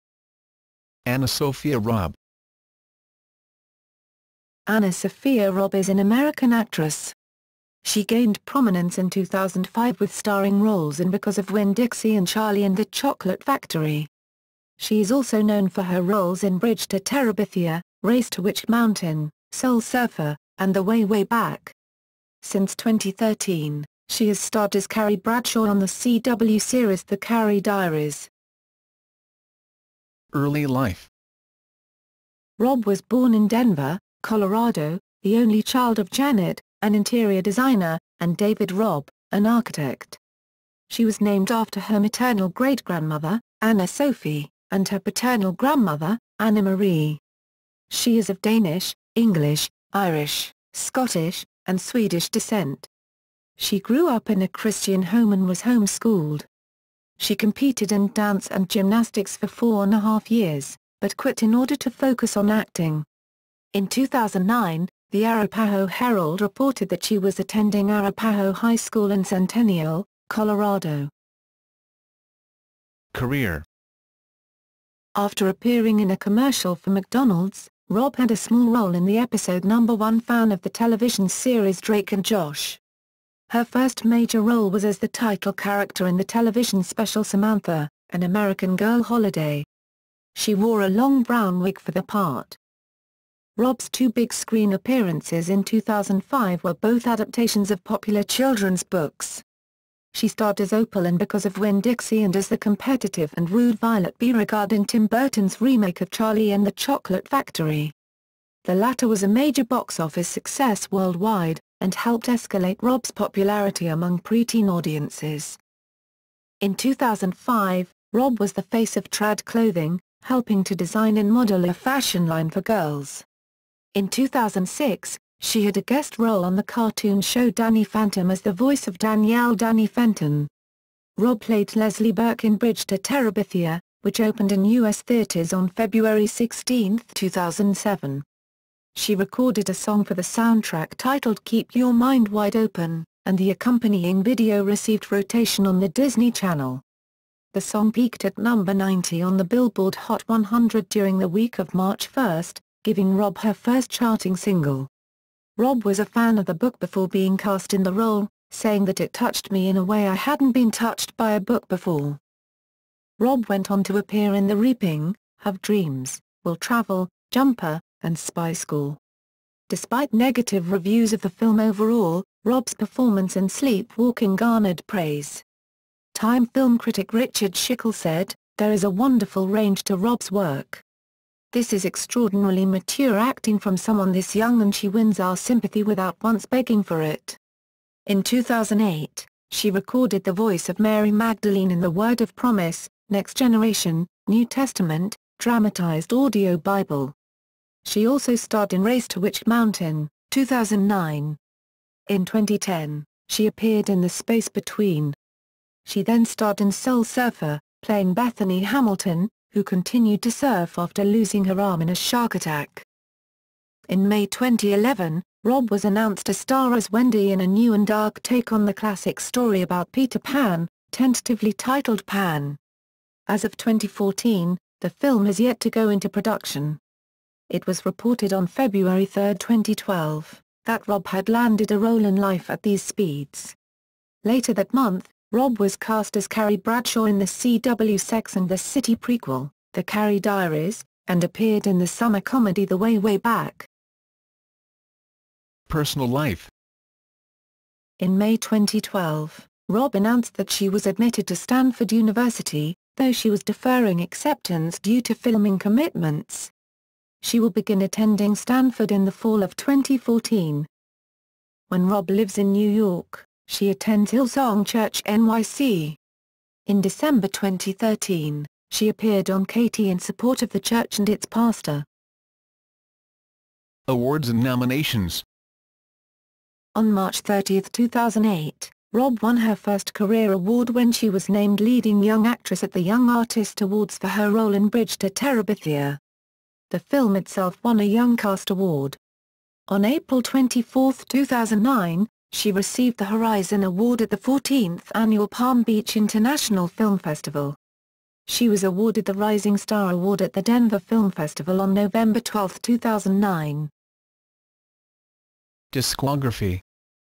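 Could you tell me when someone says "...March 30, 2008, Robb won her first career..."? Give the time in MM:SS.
04:36.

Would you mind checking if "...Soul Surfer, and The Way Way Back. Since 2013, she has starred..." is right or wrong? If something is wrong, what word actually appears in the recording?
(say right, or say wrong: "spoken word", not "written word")
right.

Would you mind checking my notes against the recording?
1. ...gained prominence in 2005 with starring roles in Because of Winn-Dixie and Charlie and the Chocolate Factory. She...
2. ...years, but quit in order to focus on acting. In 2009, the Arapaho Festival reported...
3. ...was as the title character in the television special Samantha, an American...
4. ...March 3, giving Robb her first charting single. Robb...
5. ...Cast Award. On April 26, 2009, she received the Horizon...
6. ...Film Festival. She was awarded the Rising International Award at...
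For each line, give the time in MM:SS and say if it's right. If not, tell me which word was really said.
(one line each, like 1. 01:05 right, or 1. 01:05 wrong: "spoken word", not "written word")
1. 00:08 right
2. 01:00 wrong: "Herald", not "Festival"
3. 01:24 right
4. 02:31 wrong: "1", not "3"
5. 04:48 wrong: "24", not "26"
6. 04:56 wrong: "Star", not "International".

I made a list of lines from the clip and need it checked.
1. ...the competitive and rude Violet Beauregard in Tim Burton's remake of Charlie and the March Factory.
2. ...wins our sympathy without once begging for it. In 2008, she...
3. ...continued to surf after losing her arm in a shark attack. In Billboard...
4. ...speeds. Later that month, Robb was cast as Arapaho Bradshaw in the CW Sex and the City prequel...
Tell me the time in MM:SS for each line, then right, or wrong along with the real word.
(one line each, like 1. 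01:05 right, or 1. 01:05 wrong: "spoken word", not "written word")
1. 01:42 wrong: "Chocolate", not "March"
2. 03:04 right
3. 03:29 wrong: "May", not "Billboard"
4. 03:52 wrong: "Carrie", not "Arapaho".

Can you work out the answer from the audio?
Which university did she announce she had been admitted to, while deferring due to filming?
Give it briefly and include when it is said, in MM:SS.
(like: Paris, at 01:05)
Stanford University, at 04:11.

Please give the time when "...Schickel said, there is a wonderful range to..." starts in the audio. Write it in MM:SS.
02:57.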